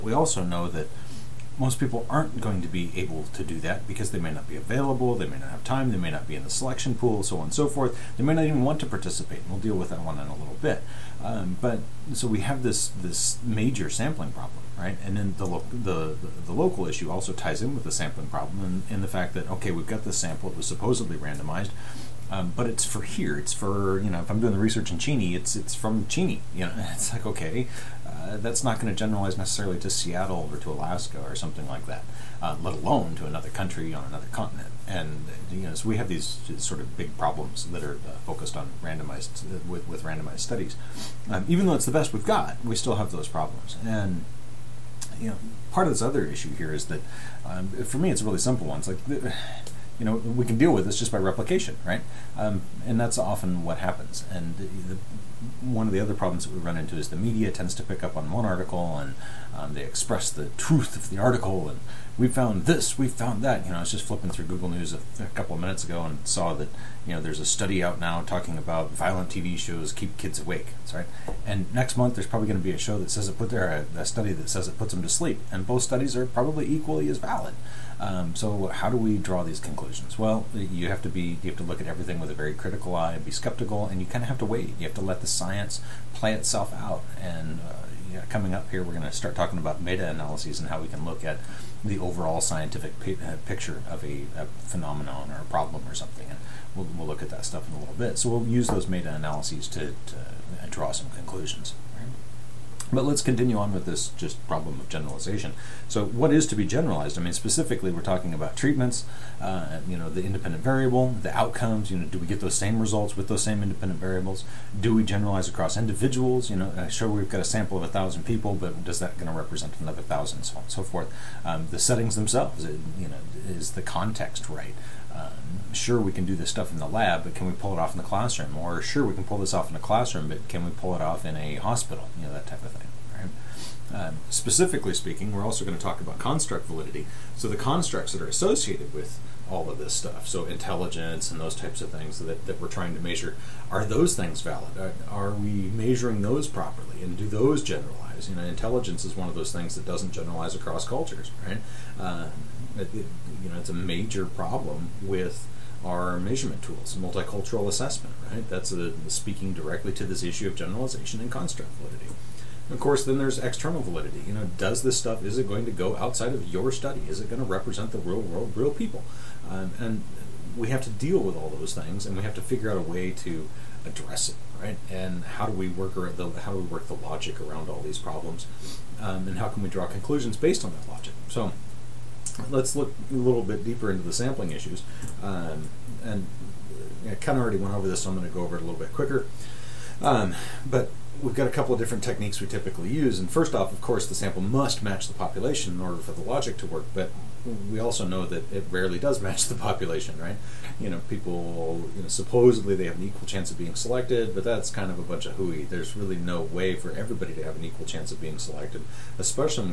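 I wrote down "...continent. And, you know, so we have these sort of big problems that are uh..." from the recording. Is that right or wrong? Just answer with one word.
right.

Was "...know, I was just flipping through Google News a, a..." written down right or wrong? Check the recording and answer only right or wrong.
right.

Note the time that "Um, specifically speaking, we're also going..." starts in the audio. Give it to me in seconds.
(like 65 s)
134 s.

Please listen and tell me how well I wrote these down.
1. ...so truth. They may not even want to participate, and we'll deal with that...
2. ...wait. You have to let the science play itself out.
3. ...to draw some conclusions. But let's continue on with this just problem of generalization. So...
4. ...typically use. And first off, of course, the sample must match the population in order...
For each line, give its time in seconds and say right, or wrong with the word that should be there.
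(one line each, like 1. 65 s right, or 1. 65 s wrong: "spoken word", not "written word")
1. 7 s wrong: "forth", not "truth"
2. 84 s right
3. 100 s right
4. 192 s right.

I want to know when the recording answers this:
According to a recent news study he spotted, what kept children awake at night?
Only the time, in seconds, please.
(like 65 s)
68 s.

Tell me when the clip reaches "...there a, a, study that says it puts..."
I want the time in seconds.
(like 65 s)
73 s.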